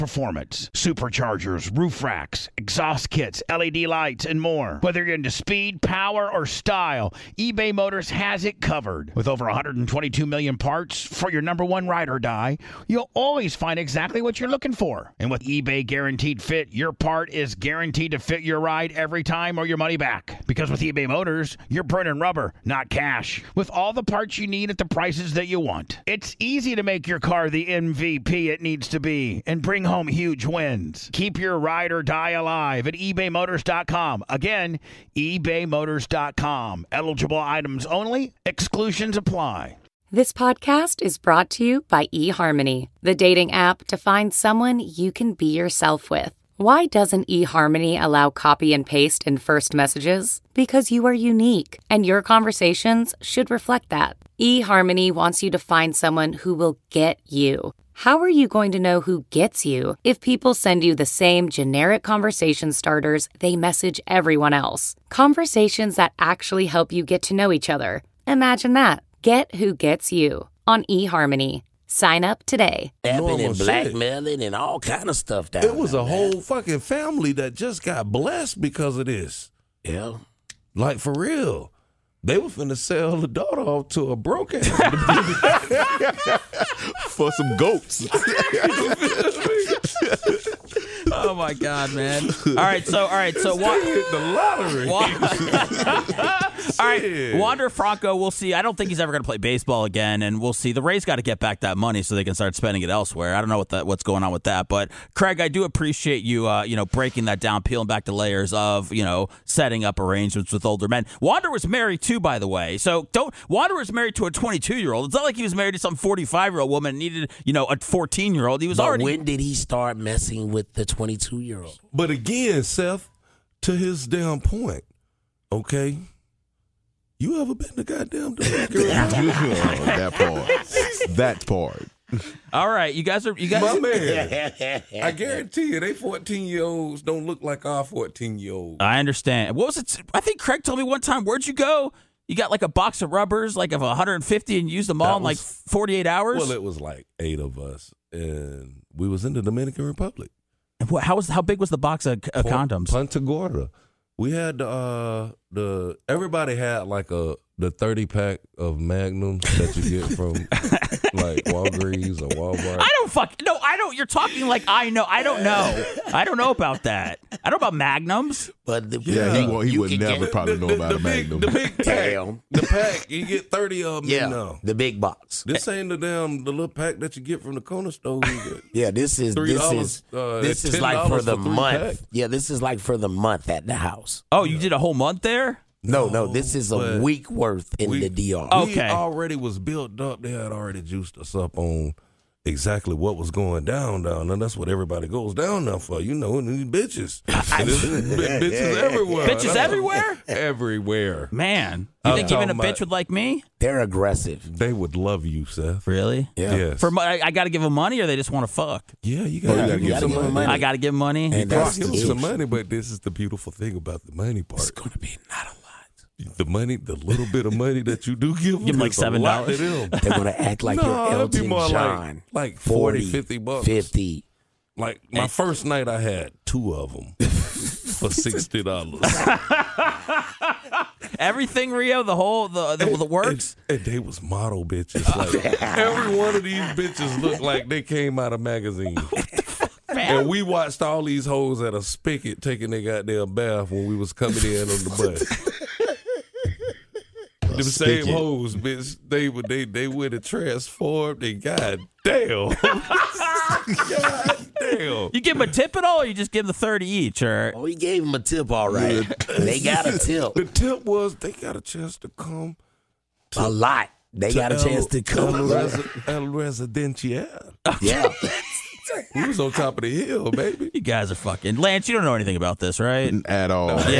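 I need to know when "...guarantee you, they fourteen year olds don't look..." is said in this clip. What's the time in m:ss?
2:15.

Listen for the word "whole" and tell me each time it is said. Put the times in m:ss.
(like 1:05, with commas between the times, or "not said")
1:16, 3:04, 3:52.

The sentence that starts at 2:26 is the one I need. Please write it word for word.
Well, it was like eight of us, and we was in the Dominican Republic.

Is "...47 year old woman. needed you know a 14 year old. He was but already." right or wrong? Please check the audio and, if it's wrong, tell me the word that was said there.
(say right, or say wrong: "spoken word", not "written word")
wrong: "45", not "47".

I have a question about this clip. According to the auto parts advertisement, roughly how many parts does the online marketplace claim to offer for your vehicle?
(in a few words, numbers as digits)
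122 million.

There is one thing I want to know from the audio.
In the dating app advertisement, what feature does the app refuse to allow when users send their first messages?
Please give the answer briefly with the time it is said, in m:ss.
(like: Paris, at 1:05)
copy and paste, at 0:48.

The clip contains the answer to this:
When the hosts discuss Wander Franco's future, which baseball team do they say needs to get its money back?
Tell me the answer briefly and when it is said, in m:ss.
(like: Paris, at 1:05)
The Rays, at 1:40.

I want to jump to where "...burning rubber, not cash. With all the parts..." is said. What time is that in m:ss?
0:21.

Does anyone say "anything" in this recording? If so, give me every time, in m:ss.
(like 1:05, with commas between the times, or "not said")
4:32.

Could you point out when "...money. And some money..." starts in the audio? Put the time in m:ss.
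3:30.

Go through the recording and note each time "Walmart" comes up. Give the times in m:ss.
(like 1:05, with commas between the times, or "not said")
2:42.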